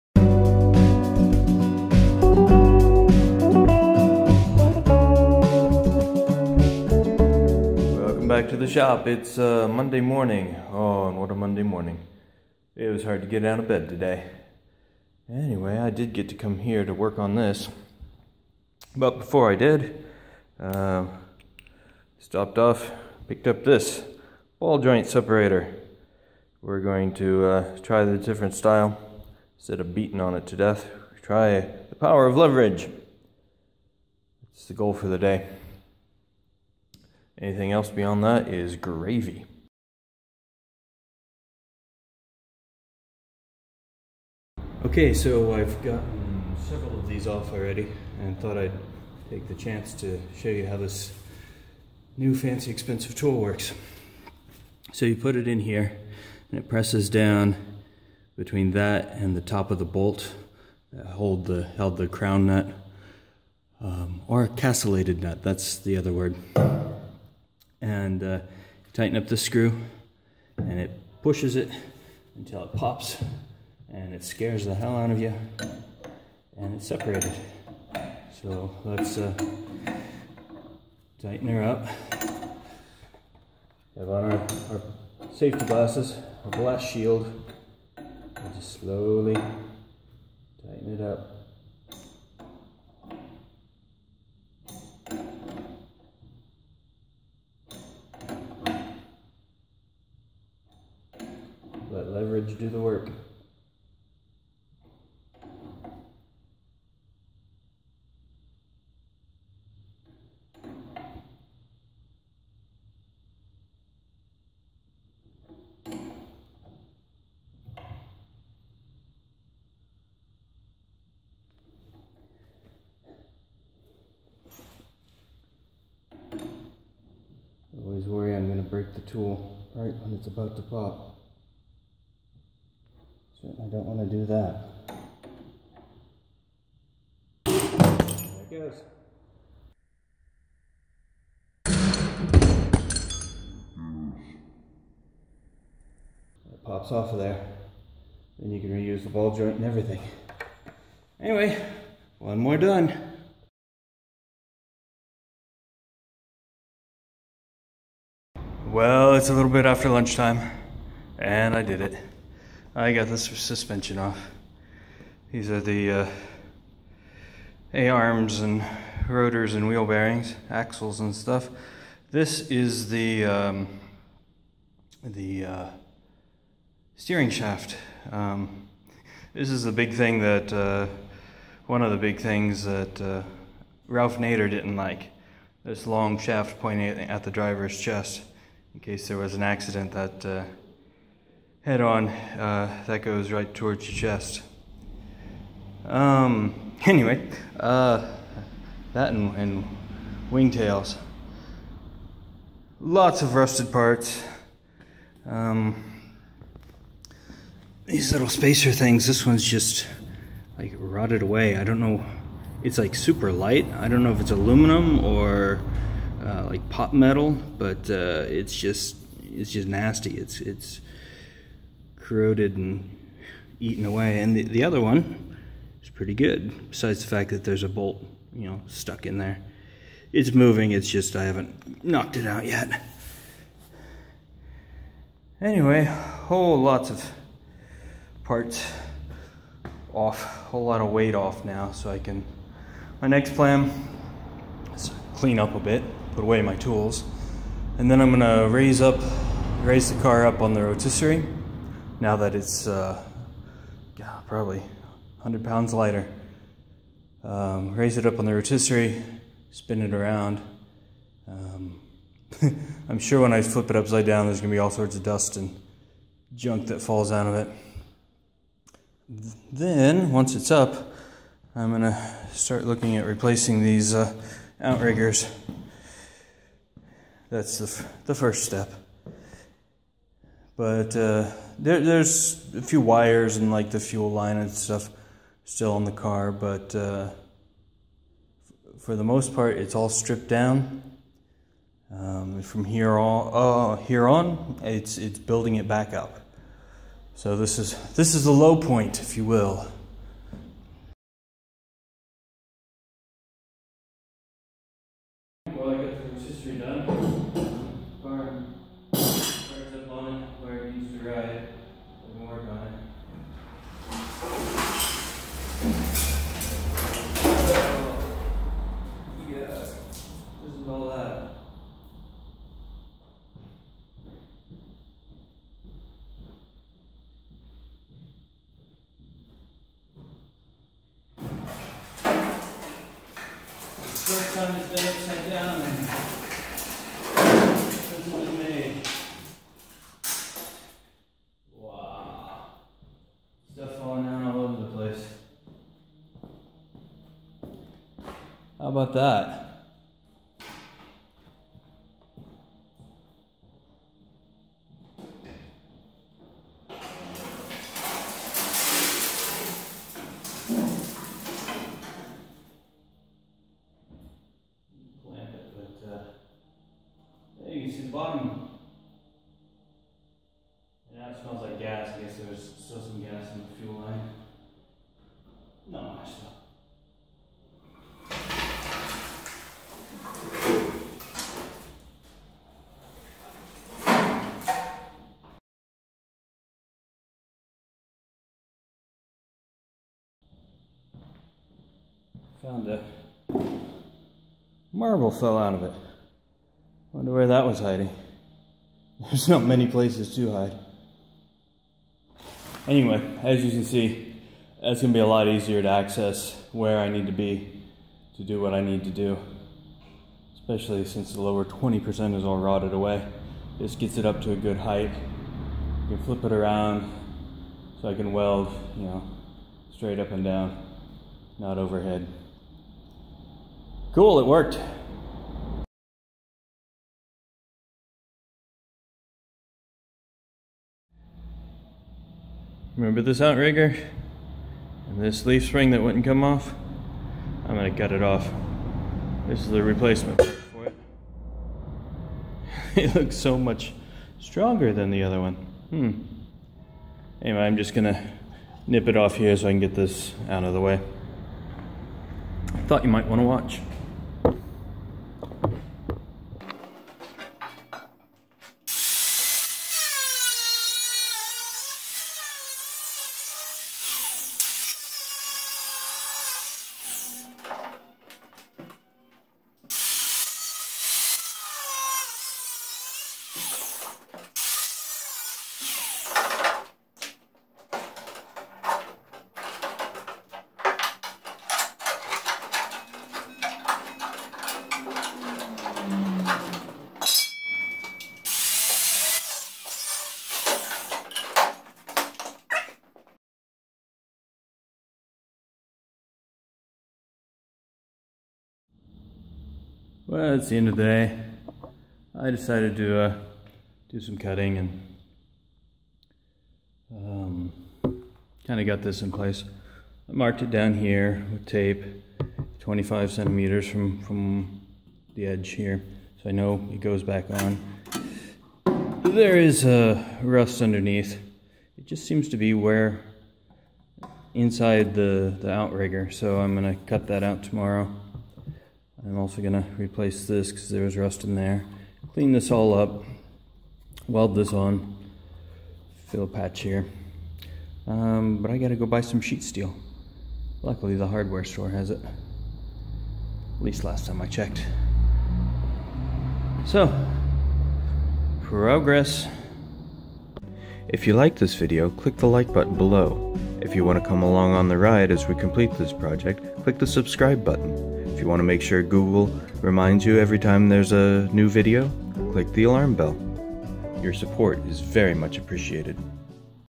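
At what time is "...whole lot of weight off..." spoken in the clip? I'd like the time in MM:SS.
04:00.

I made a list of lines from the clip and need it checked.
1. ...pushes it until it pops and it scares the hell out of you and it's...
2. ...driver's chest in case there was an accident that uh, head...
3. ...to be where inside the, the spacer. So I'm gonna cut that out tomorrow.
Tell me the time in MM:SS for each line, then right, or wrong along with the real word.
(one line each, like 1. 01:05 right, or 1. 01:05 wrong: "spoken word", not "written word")
1. 01:11 right
2. 03:07 right
3. 08:42 wrong: "outrigger", not "spacer".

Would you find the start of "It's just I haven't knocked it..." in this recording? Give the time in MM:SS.
03:50.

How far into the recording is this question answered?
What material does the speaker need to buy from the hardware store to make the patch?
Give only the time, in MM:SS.
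08:59.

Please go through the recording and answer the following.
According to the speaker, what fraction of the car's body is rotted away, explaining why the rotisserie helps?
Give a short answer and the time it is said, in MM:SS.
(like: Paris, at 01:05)
lower 20%, at 06:51.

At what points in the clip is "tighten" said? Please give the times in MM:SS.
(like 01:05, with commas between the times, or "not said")
01:08, 01:21, 01:30.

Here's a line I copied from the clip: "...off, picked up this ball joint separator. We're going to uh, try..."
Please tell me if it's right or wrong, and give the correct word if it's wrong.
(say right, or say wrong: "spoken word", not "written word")
right.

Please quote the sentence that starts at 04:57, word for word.
So this is this is the low point, if you will.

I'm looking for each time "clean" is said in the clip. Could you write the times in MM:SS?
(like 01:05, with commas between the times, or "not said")
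04:05, 08:52.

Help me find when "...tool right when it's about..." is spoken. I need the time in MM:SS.
02:09.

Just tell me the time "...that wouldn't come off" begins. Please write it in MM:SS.
07:15.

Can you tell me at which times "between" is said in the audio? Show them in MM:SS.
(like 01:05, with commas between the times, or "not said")
00:58.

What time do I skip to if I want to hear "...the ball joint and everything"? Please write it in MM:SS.
02:29.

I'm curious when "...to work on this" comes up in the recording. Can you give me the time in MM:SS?
00:16.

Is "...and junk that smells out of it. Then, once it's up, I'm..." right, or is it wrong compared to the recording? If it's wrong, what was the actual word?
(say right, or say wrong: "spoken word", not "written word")
wrong: "falls", not "smells".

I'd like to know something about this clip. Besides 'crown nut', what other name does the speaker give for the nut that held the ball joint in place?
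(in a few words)
castellated nut.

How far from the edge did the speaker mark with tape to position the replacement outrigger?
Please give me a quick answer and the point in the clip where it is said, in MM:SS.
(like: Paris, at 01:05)
25 centimeters, at 08:32.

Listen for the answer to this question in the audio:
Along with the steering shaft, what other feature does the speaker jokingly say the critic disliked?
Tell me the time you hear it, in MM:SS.
03:20.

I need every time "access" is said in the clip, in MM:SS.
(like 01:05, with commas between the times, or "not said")
06:45.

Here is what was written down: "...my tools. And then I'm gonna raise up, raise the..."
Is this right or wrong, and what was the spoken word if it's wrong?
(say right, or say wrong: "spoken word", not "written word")
right.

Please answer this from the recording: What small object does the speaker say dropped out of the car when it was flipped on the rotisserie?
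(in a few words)
a marble.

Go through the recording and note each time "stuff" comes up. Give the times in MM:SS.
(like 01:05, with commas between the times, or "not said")
02:51, 04:44.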